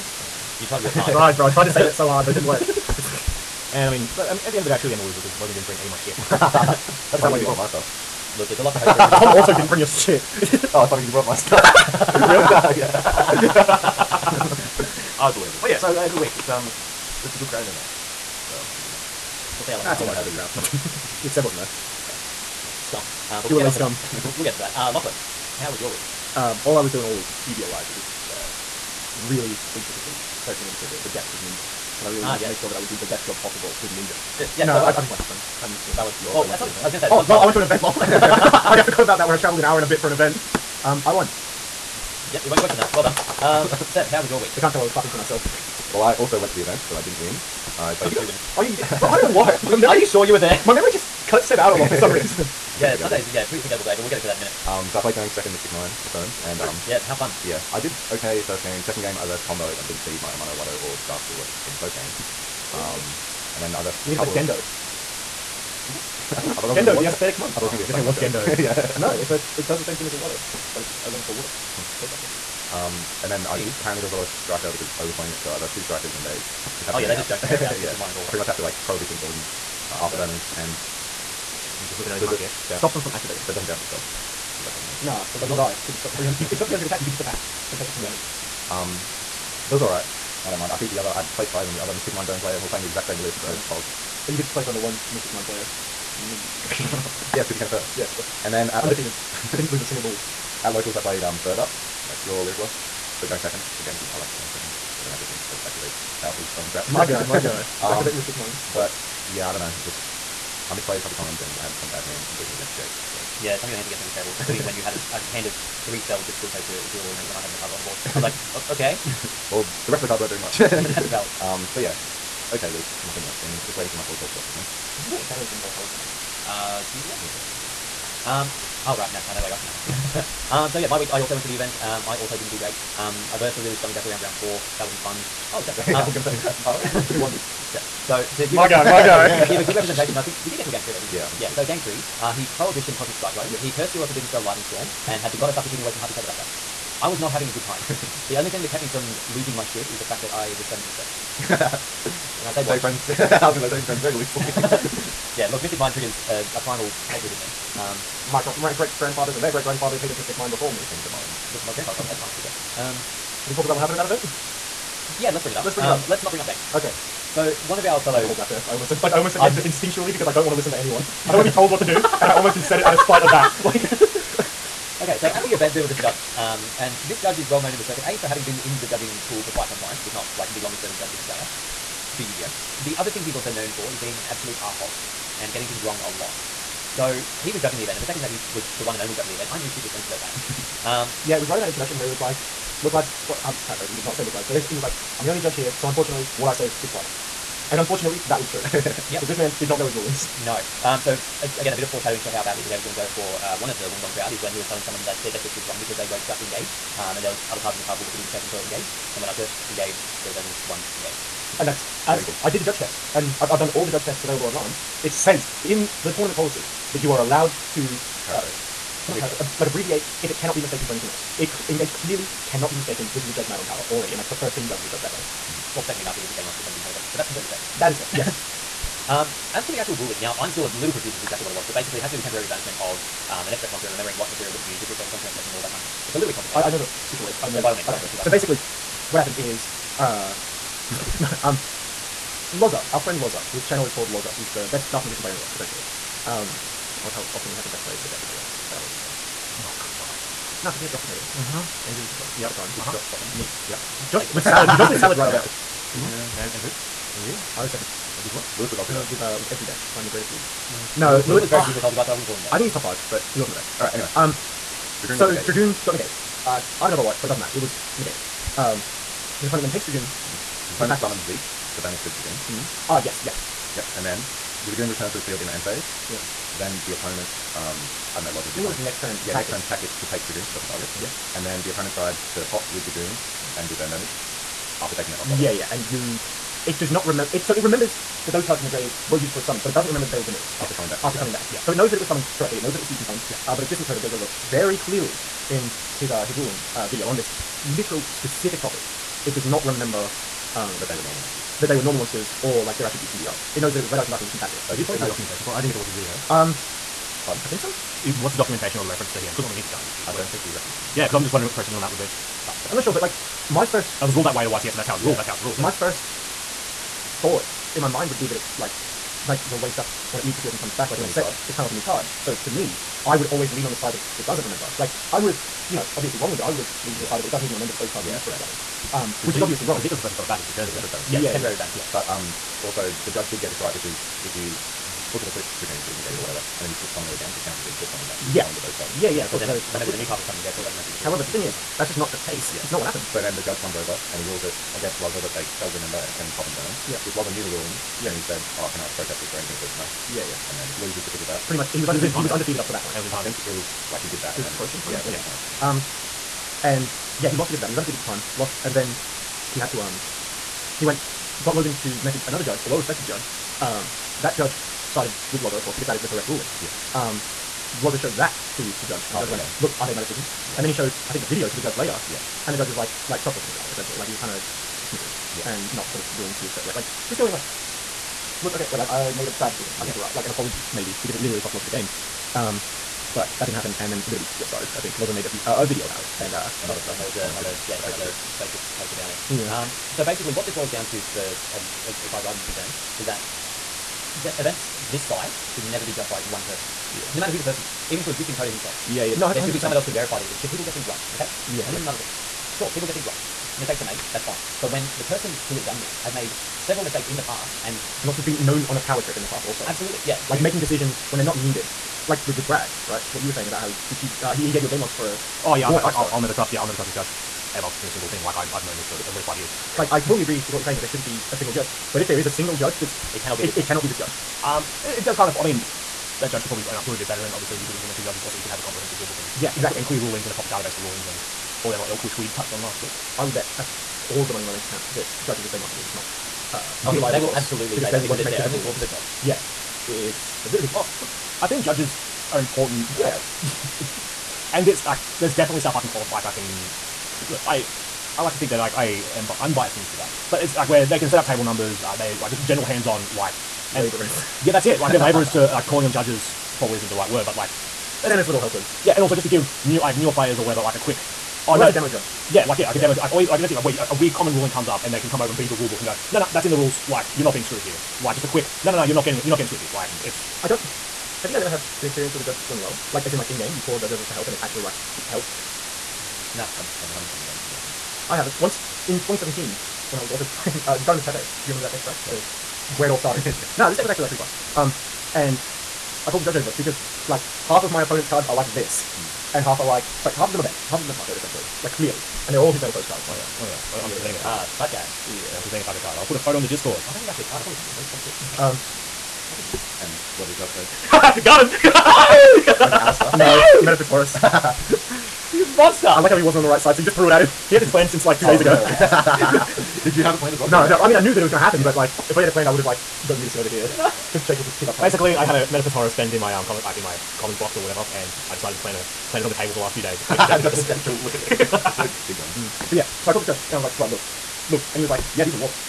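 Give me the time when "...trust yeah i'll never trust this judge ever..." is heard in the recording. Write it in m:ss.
6:56.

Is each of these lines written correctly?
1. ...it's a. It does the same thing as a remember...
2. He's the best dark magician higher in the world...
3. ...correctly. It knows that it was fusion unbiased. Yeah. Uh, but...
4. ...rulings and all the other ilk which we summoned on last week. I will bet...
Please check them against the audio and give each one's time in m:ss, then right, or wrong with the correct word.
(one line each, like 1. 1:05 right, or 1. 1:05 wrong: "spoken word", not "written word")
1. 1:09 wrong: "water", not "remember"
2. 4:04 wrong: "player", not "higher"
3. 4:52 wrong: "summoned", not "unbiased"
4. 7:10 wrong: "touched", not "summoned".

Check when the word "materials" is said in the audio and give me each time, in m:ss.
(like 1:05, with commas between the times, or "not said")
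3:54, 5:40.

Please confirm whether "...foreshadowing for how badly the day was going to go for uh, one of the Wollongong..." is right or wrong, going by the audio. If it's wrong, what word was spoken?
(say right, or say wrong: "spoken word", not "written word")
right.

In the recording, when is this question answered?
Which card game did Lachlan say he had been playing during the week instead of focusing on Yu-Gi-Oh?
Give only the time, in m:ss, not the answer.
0:35.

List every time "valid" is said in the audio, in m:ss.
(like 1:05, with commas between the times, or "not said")
0:35, 2:01.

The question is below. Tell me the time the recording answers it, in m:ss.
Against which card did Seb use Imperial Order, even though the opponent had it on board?
1:57.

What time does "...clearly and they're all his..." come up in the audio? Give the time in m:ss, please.
8:11.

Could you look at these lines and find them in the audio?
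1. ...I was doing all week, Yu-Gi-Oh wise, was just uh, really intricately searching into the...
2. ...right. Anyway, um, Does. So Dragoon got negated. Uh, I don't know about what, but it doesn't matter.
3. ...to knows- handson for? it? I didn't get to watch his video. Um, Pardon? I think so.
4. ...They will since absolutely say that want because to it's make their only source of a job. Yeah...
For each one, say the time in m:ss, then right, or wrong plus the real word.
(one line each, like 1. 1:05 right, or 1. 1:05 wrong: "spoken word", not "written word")
1. 0:26 right
2. 4:23 wrong: "Dragoon", not "Does"
3. 5:04 wrong: "documentation", not "handson"
4. 7:17 wrong: "source", not "since".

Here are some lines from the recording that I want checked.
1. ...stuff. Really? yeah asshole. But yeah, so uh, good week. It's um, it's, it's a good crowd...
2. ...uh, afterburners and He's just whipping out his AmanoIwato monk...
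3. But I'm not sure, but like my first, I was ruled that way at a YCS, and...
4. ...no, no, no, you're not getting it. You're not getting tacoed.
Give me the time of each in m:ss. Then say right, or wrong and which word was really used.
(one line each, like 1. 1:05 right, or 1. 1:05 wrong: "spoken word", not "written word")
1. 0:11 wrong: "unbelievable", not "asshole"
2. 1:19 wrong: "Does", not "AmanoIwato"
3. 5:12 right
4. 7:48 wrong: "swifted", not "tacoed".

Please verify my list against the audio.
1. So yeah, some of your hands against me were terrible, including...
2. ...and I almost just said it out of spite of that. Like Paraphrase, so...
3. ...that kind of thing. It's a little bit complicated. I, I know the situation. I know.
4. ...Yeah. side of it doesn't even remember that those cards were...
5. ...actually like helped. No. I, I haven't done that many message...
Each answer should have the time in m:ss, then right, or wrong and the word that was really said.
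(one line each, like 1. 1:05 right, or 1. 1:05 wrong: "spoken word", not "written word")
1. 1:53 right
2. 2:51 wrong: "Okay", not "Paraphrase"
3. 3:55 right
4. 5:27 right
5. 7:54 wrong: "judge", not "message".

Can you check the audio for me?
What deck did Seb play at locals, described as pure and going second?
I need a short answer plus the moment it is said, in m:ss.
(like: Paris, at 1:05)
Lyrilusc, at 1:42.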